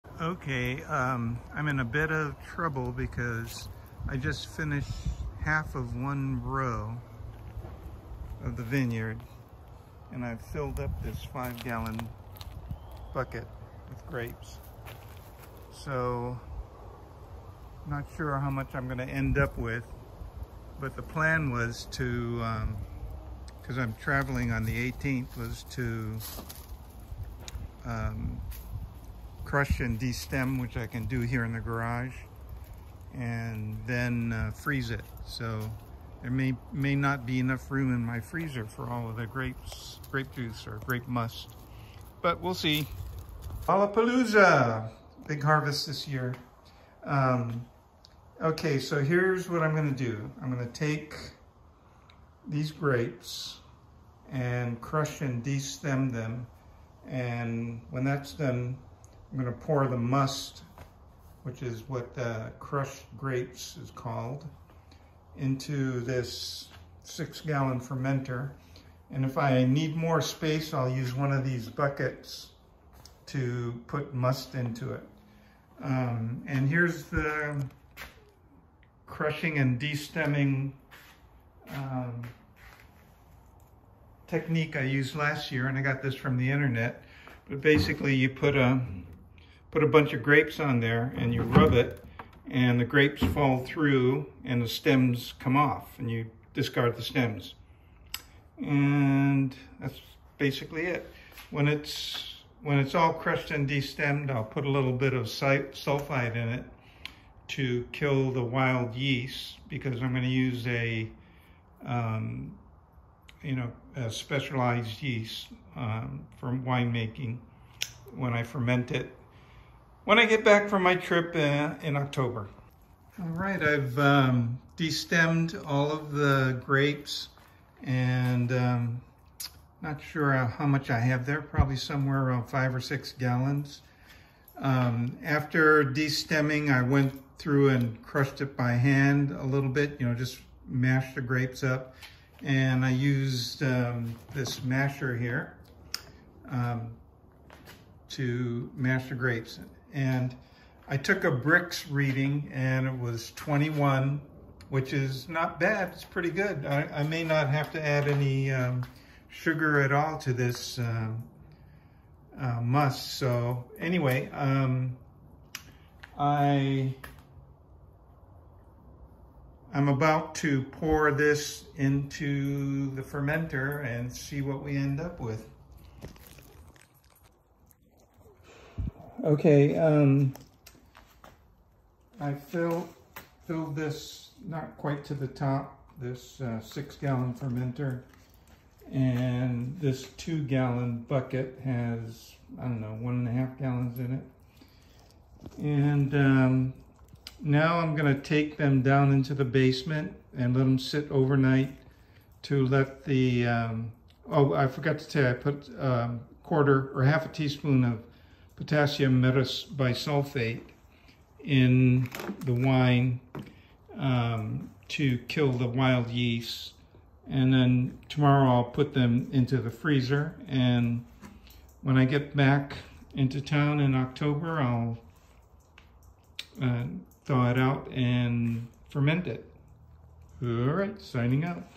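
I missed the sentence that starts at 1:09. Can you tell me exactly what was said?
And if I need more space, I'll use one of these buckets to put must into it.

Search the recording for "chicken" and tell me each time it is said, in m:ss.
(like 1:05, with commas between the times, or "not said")
not said.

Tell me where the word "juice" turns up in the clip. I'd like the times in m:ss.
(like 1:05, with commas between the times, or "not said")
0:40.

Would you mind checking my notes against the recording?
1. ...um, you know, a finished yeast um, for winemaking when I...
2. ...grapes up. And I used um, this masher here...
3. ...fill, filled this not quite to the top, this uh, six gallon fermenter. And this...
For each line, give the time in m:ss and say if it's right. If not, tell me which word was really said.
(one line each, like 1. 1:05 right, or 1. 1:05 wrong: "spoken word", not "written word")
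1. 1:51 wrong: "specialized", not "finished"
2. 2:21 right
3. 3:02 right.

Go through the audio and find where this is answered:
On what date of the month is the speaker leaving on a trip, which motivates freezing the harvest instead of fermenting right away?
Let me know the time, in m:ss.
0:24.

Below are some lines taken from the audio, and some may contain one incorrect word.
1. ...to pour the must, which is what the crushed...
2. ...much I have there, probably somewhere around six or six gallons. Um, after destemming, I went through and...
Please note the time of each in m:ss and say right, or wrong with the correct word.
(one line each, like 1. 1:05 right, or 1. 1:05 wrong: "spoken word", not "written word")
1. 0:59 right
2. 2:10 wrong: "five", not "six".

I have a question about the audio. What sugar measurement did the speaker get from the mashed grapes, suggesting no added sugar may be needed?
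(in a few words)
21 Brix.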